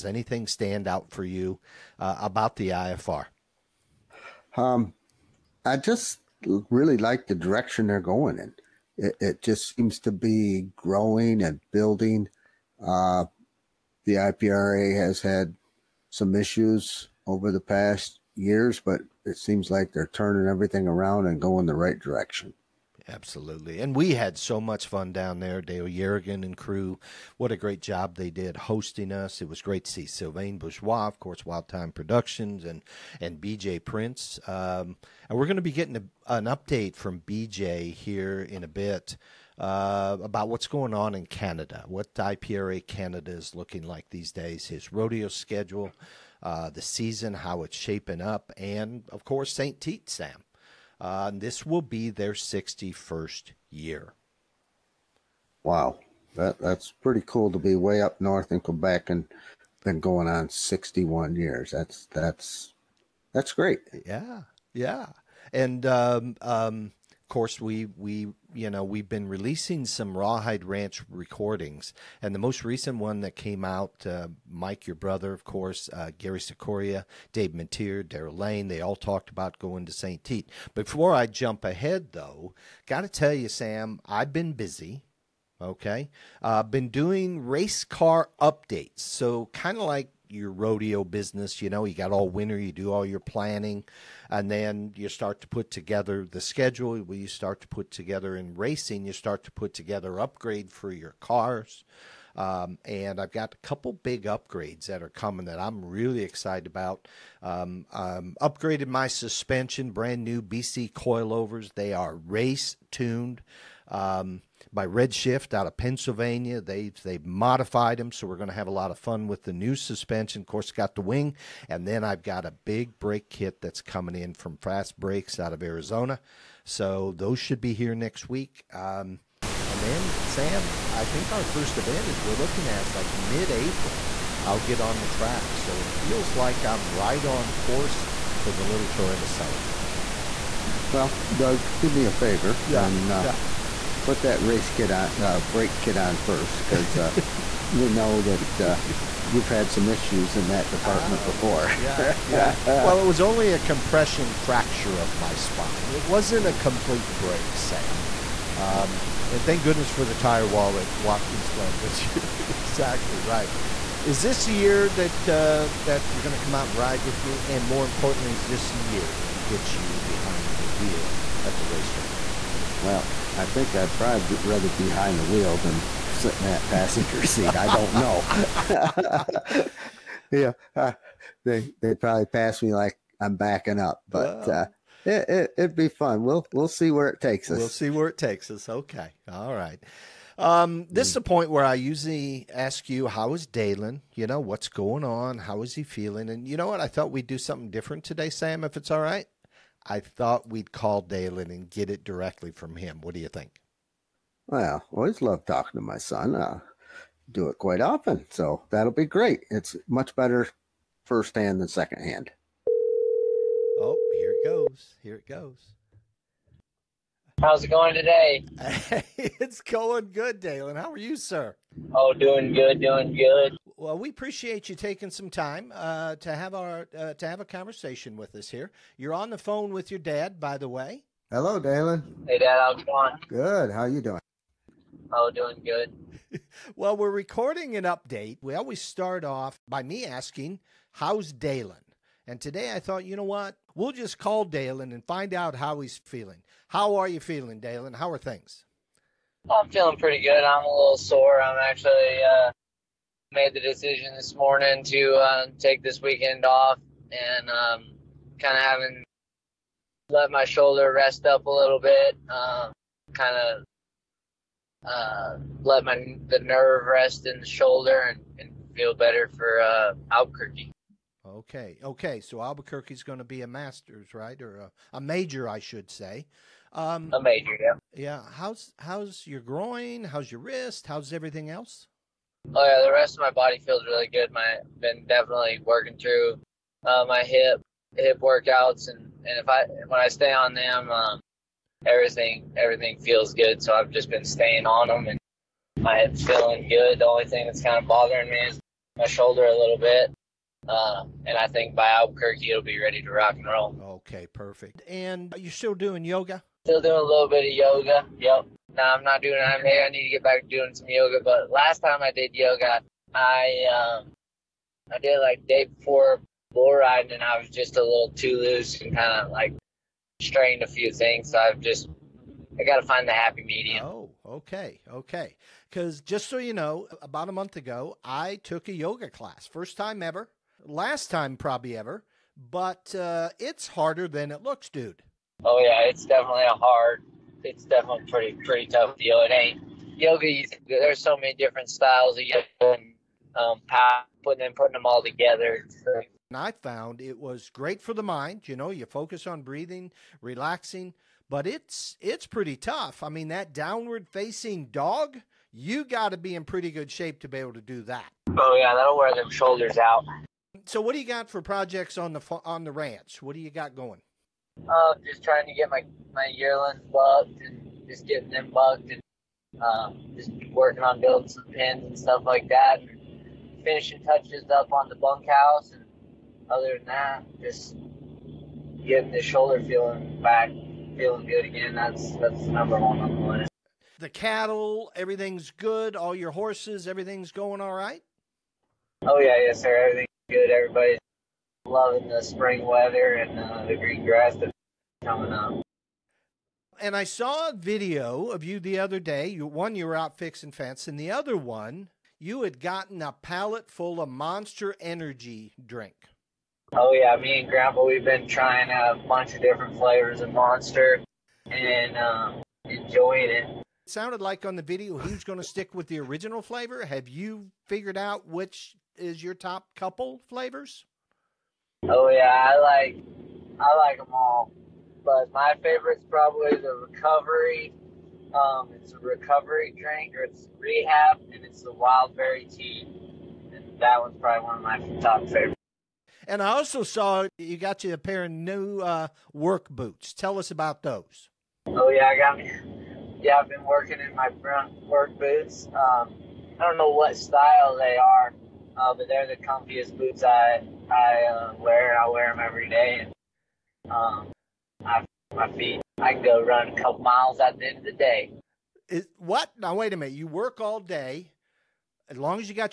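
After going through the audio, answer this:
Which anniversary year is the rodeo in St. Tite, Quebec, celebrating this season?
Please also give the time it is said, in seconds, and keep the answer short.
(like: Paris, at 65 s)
61st, at 52 s.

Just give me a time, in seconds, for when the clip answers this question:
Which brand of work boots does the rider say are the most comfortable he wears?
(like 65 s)
444 s.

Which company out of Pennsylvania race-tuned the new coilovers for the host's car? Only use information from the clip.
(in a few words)
Redshift.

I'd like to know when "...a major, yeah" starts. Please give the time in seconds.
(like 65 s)
277 s.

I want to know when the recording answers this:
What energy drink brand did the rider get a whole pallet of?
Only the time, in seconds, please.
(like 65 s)
404 s.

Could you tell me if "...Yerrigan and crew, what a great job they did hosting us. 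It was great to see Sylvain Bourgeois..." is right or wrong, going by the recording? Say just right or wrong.
right.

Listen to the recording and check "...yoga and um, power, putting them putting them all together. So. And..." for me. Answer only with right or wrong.
right.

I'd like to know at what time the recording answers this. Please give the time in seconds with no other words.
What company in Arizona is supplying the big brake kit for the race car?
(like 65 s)
124 s.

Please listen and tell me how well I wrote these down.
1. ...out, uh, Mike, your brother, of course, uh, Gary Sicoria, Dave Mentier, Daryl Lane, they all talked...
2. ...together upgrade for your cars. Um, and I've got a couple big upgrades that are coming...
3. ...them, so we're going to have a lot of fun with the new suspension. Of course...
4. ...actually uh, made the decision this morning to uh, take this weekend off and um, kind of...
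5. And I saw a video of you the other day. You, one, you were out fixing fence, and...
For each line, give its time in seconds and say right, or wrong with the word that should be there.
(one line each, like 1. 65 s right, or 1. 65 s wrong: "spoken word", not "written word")
1. 73 s right
2. 99 s right
3. 117 s right
4. 251 s right
5. 396 s right.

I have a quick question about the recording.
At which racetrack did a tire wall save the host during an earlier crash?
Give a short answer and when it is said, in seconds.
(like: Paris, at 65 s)
Watkins Glen, at 160 s.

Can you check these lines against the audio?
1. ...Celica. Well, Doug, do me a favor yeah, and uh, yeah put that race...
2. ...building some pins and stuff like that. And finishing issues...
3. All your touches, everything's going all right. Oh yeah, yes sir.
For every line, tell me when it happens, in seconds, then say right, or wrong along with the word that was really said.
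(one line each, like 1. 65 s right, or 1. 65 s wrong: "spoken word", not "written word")
1. 139 s right
2. 370 s wrong: "touches", not "issues"
3. 385 s wrong: "horses", not "touches".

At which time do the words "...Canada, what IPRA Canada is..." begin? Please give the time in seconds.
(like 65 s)
41 s.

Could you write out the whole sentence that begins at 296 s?
The only thing that's kind of bothering me is my shoulder a little bit.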